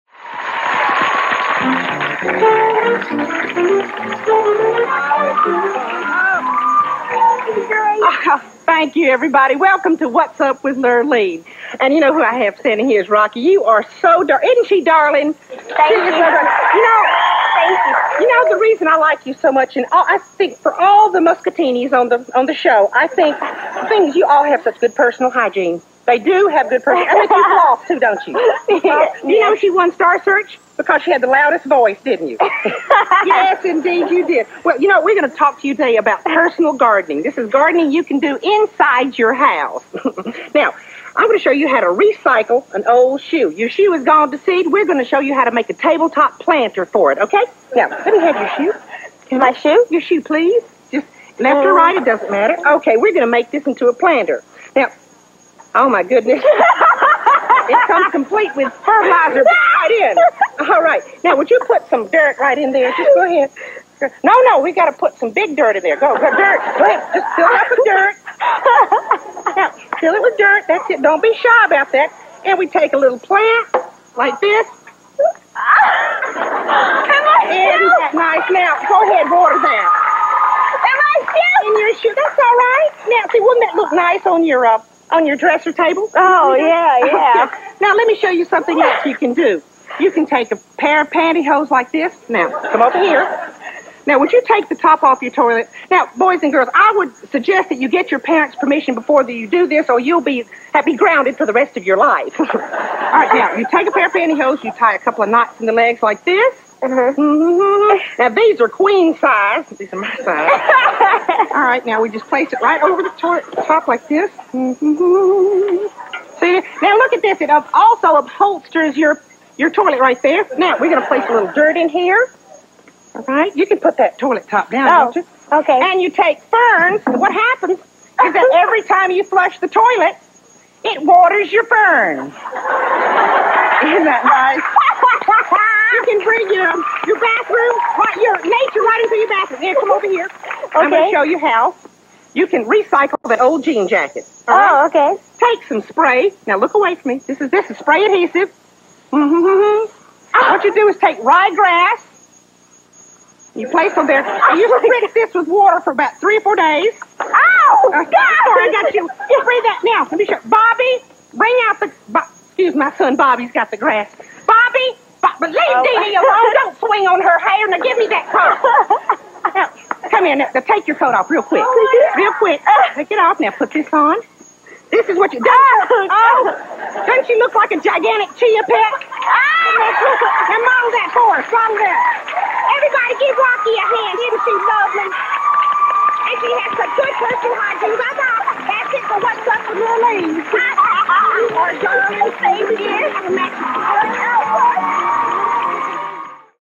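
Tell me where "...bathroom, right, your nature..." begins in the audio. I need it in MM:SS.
02:17.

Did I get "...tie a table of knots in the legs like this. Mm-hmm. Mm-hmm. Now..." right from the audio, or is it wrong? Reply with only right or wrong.
wrong.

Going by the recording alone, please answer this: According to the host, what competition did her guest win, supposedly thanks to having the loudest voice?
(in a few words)
Star Search.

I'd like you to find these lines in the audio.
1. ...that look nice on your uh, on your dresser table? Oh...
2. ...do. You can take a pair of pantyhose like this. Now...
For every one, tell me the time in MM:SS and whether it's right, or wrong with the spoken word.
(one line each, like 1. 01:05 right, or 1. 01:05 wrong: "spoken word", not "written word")
1. 01:23 right
2. 01:29 right.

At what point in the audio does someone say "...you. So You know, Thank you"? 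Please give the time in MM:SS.
00:15.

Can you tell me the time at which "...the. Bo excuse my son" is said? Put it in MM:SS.
02:41.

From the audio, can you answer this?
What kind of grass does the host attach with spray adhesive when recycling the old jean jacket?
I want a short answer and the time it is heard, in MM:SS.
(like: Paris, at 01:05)
Ryegrass, at 02:31.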